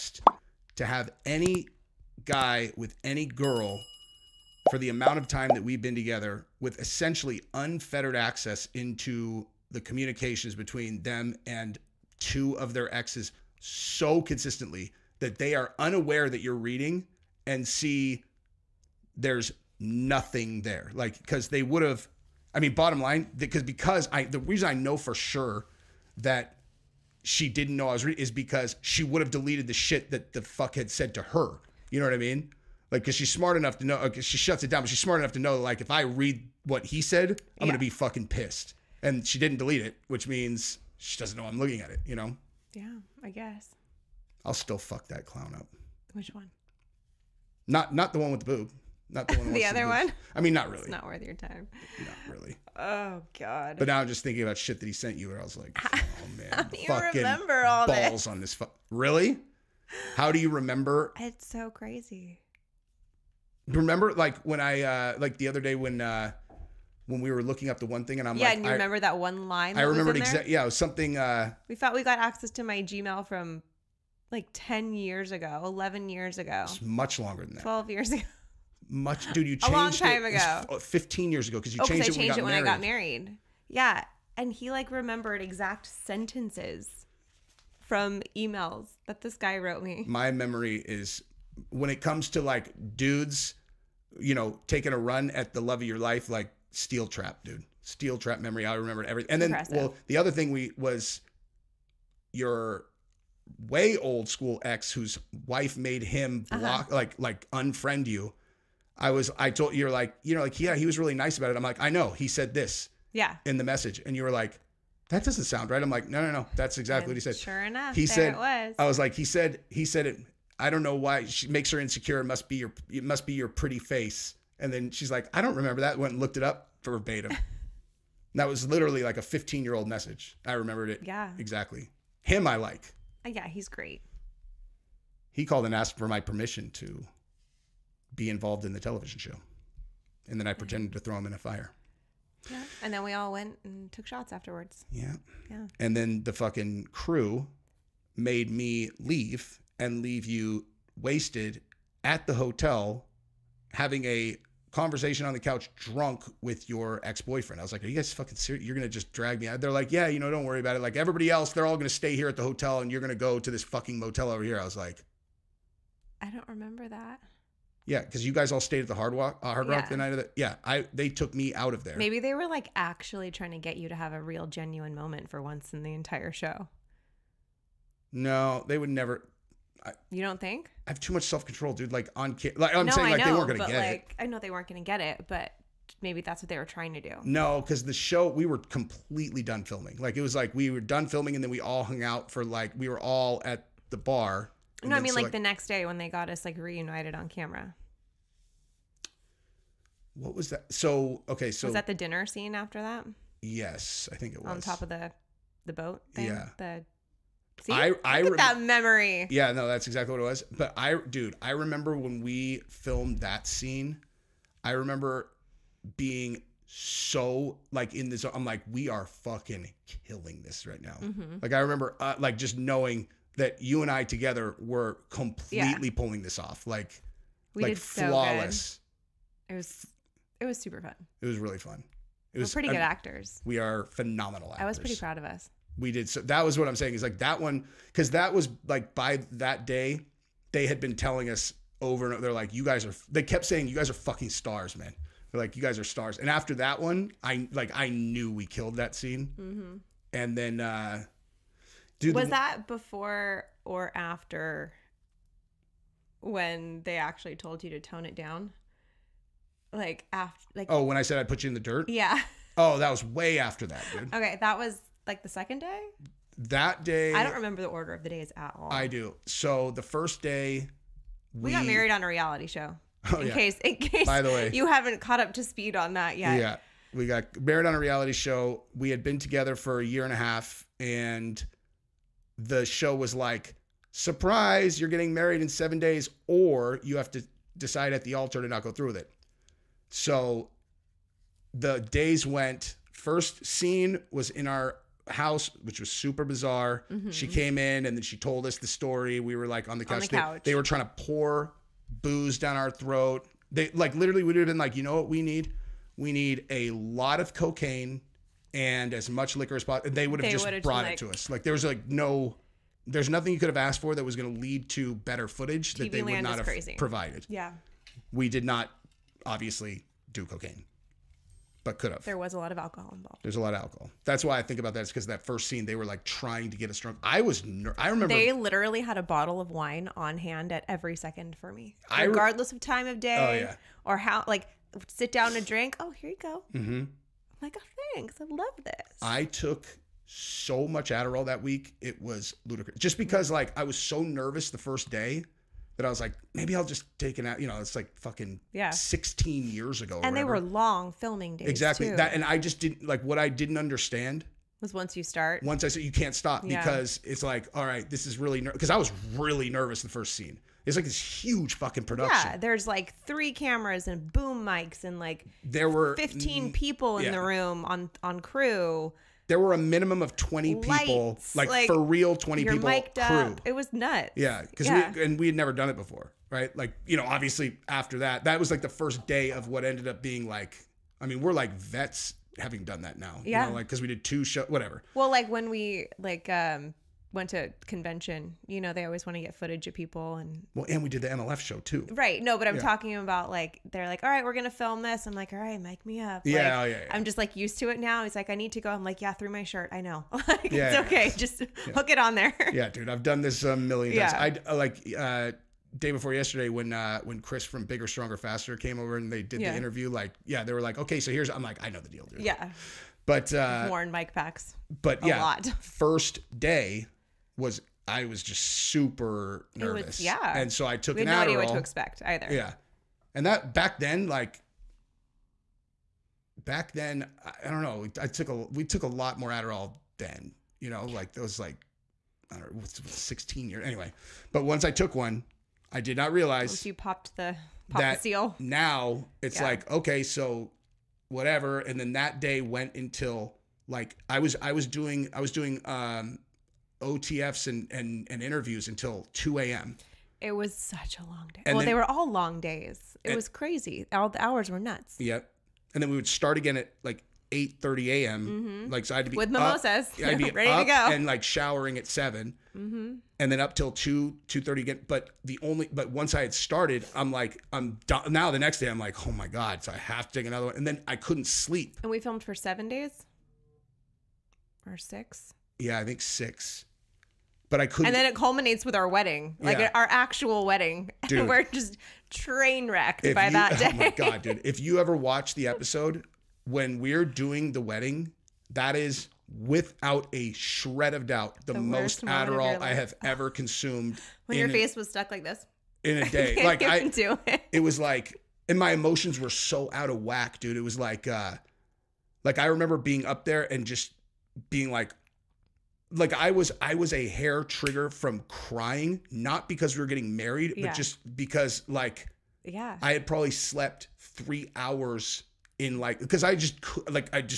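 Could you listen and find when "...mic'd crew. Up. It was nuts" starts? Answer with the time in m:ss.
6:12.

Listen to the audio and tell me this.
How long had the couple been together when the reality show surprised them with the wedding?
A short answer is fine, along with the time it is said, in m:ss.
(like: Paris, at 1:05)
A year and a half, at 4:39.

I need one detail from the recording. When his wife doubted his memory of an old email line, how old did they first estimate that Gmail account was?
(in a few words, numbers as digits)
10 years.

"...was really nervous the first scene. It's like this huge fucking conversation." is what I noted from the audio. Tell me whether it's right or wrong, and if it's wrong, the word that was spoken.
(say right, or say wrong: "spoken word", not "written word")
wrong: "production", not "conversation".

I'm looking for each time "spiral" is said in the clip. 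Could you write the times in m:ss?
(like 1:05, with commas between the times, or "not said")
not said.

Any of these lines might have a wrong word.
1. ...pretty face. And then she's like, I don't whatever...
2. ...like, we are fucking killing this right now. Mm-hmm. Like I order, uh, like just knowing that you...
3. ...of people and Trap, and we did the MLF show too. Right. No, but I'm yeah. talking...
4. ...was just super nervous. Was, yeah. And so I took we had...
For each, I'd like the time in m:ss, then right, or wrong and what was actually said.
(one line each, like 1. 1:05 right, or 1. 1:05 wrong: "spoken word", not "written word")
1. 2:03 wrong: "remember", not "whatever"
2. 3:38 wrong: "remember", not "order"
3. 6:29 wrong: "Well", not "Trap"
4. 6:58 right.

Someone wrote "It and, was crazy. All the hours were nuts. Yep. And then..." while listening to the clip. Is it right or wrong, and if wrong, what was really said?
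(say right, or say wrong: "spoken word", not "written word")
right.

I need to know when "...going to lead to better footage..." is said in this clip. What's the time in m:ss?
5:14.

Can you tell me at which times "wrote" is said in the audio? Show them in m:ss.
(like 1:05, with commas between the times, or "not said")
1:29.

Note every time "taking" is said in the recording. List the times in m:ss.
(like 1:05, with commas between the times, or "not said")
1:34.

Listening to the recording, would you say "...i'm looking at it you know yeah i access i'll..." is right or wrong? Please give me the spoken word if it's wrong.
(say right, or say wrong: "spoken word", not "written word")
wrong: "guess", not "access".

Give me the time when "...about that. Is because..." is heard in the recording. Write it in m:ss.
5:24.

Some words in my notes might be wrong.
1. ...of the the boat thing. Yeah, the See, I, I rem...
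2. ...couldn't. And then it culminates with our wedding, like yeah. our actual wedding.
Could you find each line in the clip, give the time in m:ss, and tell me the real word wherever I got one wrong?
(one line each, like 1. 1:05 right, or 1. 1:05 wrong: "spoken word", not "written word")
1. 3:24 right
2. 7:57 right.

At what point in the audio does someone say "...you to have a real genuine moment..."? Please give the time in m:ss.
2:53.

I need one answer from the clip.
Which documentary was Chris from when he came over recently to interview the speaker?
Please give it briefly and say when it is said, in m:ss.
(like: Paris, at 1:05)
Bigger, Stronger, Faster, at 6:47.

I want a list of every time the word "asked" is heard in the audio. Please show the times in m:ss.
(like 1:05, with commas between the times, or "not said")
2:15, 5:13.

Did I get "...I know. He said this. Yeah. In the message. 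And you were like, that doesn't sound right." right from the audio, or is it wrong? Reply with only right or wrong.
right.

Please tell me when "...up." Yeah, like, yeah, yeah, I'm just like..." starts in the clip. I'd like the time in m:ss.
6:35.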